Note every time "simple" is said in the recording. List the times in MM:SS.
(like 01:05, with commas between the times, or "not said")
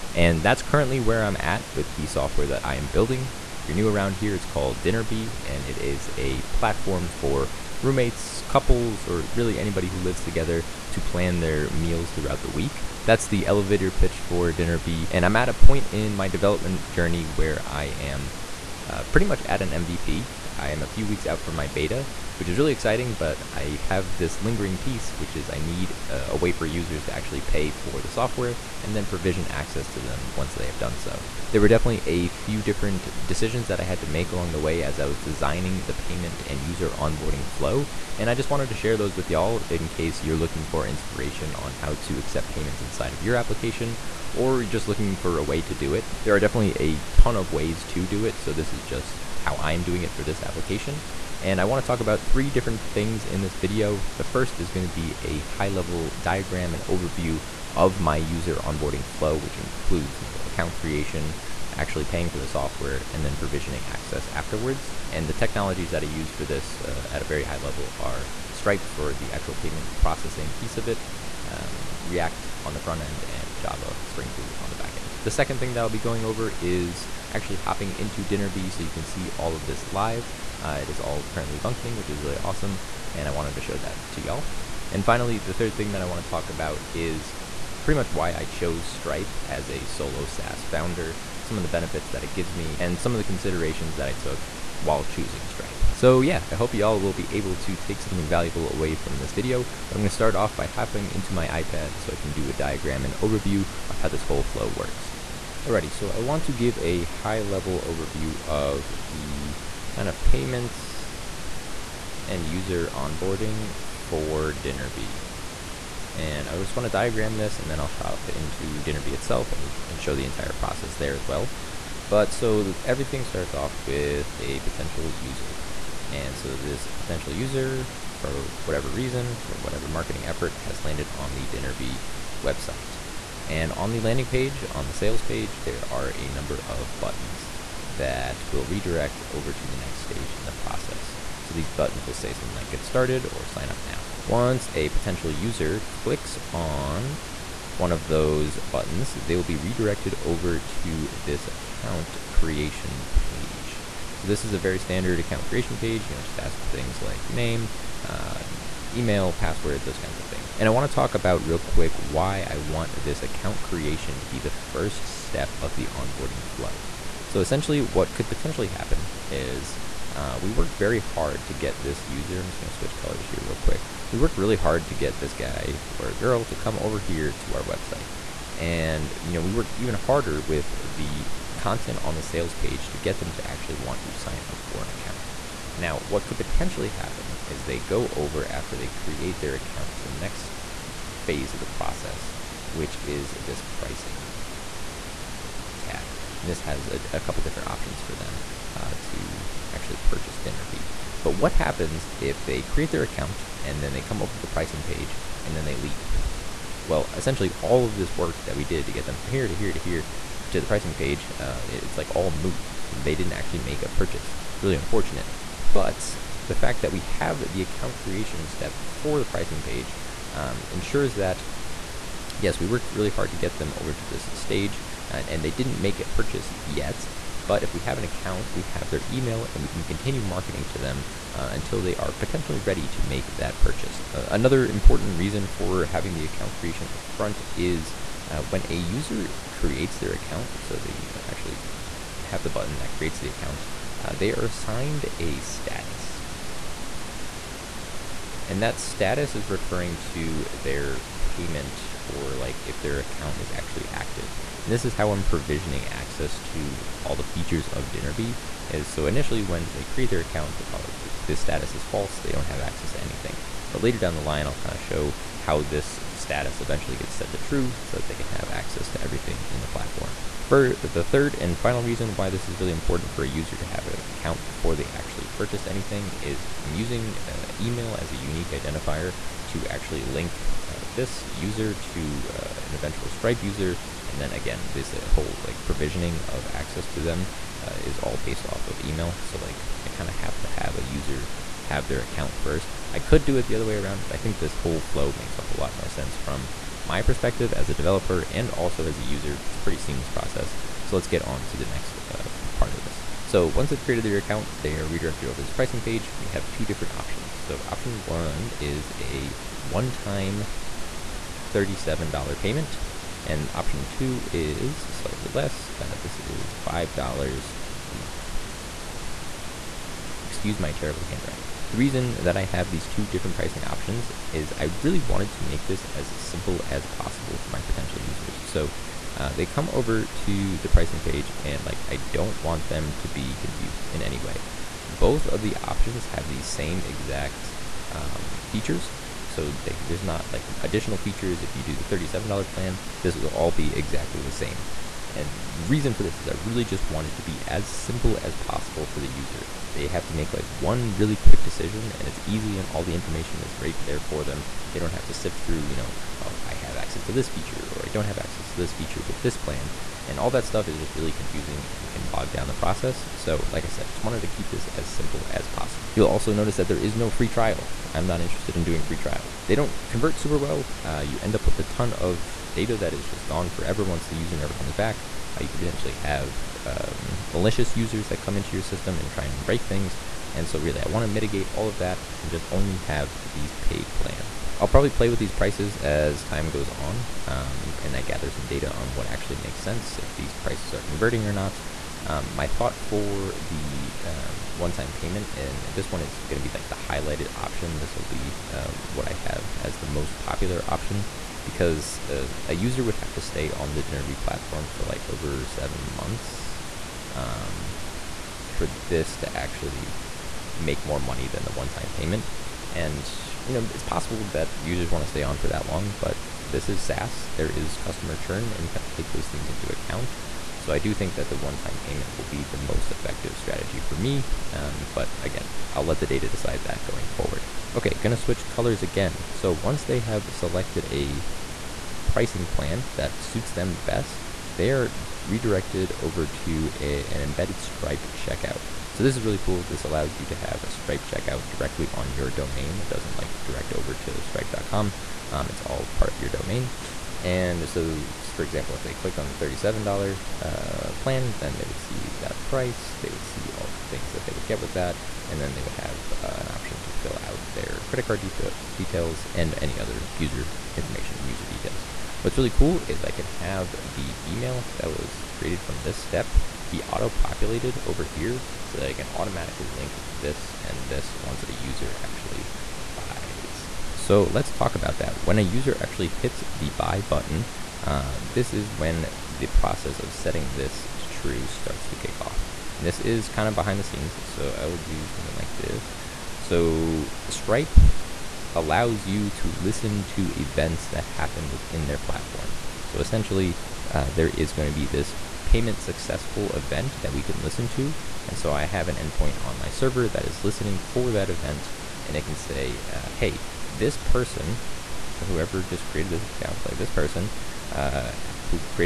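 05:26, 05:47, 06:04.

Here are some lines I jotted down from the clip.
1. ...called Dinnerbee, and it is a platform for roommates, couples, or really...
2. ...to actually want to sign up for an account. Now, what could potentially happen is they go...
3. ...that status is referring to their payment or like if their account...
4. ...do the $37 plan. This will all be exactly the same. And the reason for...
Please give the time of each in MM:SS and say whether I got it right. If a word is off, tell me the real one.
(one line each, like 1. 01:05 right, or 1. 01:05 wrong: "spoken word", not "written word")
1. 00:04 right
2. 03:03 right
3. 04:08 right
4. 05:41 right.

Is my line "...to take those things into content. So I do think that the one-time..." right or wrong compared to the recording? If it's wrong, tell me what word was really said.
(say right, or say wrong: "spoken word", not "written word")
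wrong: "account", not "content".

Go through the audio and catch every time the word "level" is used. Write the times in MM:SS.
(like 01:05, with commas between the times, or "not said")
00:55, 01:07, 01:47.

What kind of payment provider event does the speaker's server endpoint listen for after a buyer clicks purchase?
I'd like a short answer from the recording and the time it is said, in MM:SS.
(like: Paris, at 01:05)
Payment successful event, at 08:15.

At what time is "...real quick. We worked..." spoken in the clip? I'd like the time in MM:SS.
02:53.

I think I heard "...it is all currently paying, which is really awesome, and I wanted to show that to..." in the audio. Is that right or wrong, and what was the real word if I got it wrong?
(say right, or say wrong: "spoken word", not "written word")
wrong: "functioning", not "paying".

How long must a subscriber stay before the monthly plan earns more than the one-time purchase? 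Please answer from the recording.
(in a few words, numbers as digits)
Over seven months.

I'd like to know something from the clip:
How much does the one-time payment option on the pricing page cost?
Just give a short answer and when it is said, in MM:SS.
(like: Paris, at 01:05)
$37, at 05:09.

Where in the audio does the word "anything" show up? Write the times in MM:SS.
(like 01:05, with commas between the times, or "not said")
04:23, 04:35.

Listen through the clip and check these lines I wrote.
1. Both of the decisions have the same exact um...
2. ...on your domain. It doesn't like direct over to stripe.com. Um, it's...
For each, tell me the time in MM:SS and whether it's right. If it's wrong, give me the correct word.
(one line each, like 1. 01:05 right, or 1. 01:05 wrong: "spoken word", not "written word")
1. 05:34 wrong: "options", not "decisions"
2. 07:21 right.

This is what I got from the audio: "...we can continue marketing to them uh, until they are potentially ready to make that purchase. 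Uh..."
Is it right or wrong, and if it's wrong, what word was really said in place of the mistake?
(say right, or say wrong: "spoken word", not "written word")
right.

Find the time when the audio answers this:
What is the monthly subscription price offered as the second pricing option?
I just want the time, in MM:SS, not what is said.
05:16.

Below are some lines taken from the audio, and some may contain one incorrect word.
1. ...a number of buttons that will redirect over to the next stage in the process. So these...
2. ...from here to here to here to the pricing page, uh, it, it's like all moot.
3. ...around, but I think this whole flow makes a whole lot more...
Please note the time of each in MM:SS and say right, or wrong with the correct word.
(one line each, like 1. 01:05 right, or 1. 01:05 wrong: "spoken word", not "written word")
1. 02:16 right
2. 03:29 right
3. 04:53 right.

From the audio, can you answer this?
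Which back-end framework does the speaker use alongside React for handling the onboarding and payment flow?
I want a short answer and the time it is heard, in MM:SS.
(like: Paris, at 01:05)
Java Spring Boot, at 01:13.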